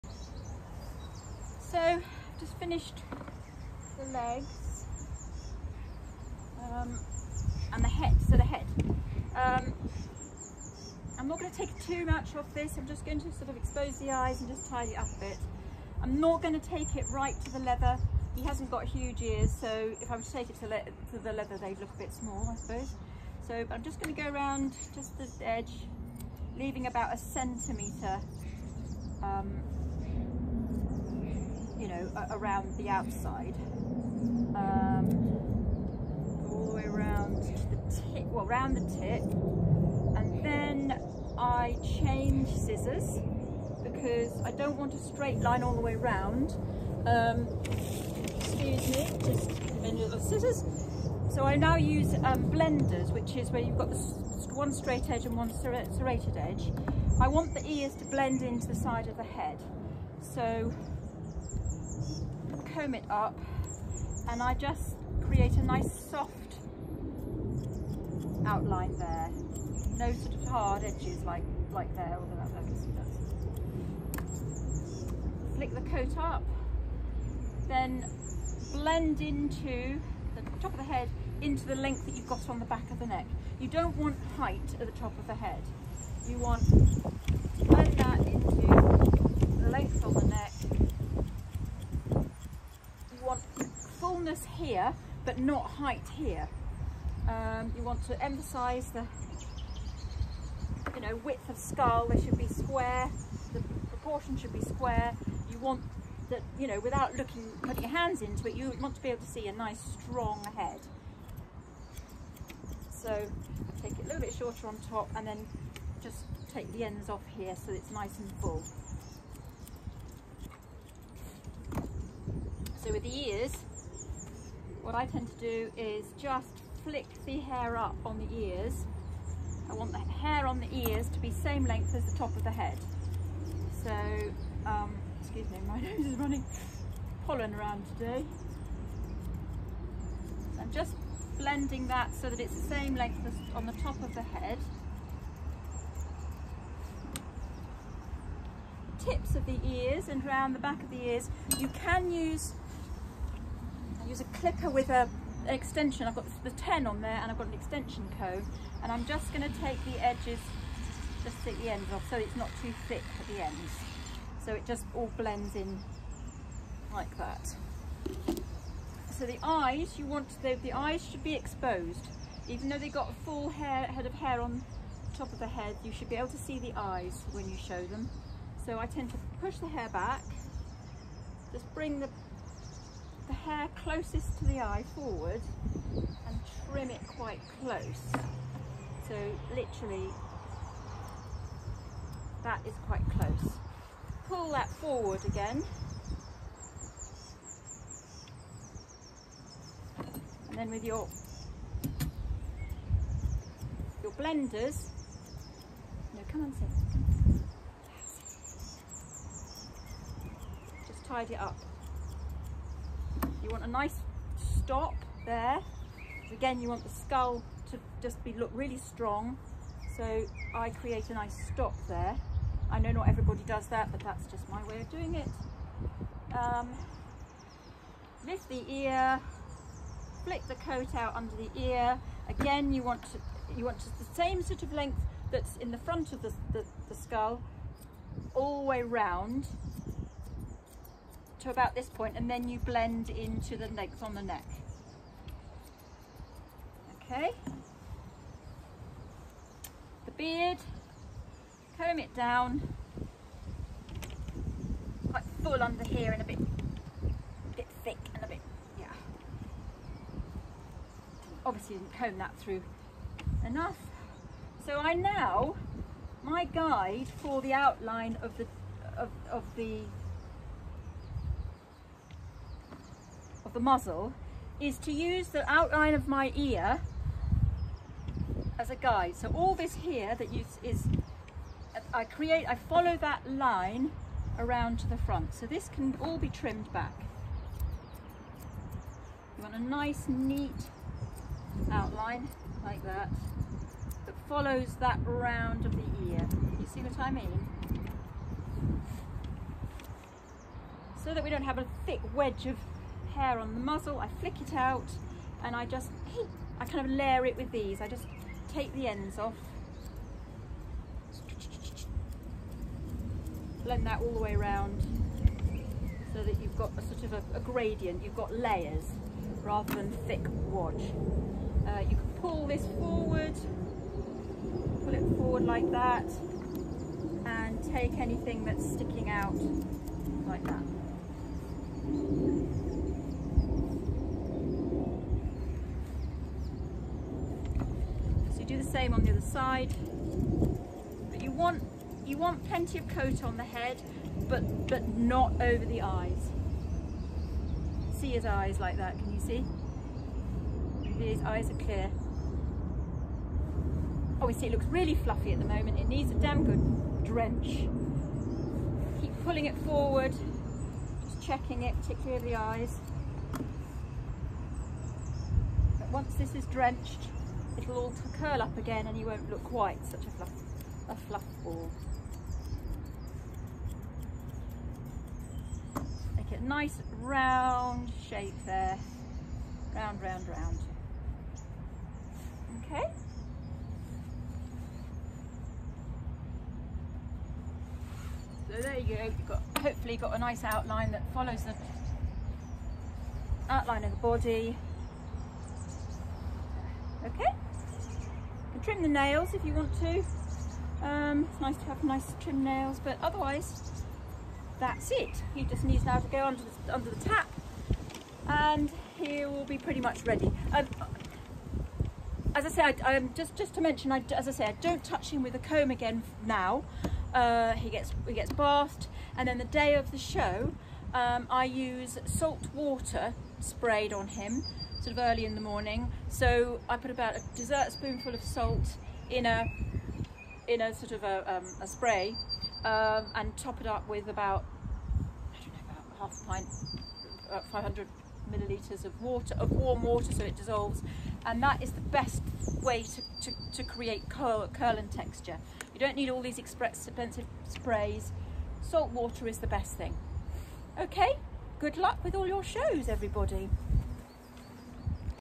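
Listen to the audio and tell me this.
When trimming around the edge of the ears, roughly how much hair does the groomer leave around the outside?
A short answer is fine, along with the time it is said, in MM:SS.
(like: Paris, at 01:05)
about a centimetre, at 00:26.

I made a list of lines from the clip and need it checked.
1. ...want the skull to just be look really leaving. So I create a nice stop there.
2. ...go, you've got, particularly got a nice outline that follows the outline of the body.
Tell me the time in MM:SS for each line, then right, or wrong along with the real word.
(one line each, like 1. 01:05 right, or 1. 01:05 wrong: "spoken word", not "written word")
1. 03:36 wrong: "strong", not "leaving"
2. 06:28 wrong: "hopefully", not "particularly".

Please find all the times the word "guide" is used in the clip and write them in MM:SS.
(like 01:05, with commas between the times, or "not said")
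04:26, 04:38.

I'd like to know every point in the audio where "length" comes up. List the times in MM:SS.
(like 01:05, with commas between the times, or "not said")
01:21, 01:29, 02:11, 02:22, 03:54.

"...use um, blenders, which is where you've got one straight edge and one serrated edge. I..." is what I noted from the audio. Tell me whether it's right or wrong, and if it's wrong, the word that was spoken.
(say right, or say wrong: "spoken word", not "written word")
right.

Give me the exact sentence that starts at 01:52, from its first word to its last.
So take it a little bit shorter on top and then just take the ends off here so it's nice and full.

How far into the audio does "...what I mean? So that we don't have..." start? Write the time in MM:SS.
04:56.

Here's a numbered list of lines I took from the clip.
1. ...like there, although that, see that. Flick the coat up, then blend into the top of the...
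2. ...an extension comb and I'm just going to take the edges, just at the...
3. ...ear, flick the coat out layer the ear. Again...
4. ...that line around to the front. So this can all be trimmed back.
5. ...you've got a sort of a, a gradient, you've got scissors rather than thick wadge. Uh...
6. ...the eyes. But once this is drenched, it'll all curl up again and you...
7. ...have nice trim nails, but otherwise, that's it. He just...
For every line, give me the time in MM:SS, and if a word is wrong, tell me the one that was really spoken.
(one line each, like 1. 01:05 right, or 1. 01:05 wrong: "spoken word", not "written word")
1. 01:11 right
2. 02:37 right
3. 03:48 wrong: "under", not "layer"
4. 04:43 right
5. 05:16 wrong: "layers", not "scissors"
6. 06:02 right
7. 06:41 right.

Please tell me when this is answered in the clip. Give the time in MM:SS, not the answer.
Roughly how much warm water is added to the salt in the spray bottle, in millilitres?
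07:17.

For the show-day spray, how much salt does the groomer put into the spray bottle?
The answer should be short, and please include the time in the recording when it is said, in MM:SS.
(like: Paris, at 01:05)
a dessert spoonful, at 07:07.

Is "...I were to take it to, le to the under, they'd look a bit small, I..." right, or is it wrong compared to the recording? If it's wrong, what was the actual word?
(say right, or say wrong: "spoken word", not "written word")
wrong: "leather", not "under".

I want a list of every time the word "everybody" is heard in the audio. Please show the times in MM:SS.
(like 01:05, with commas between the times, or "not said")
03:43, 07:32.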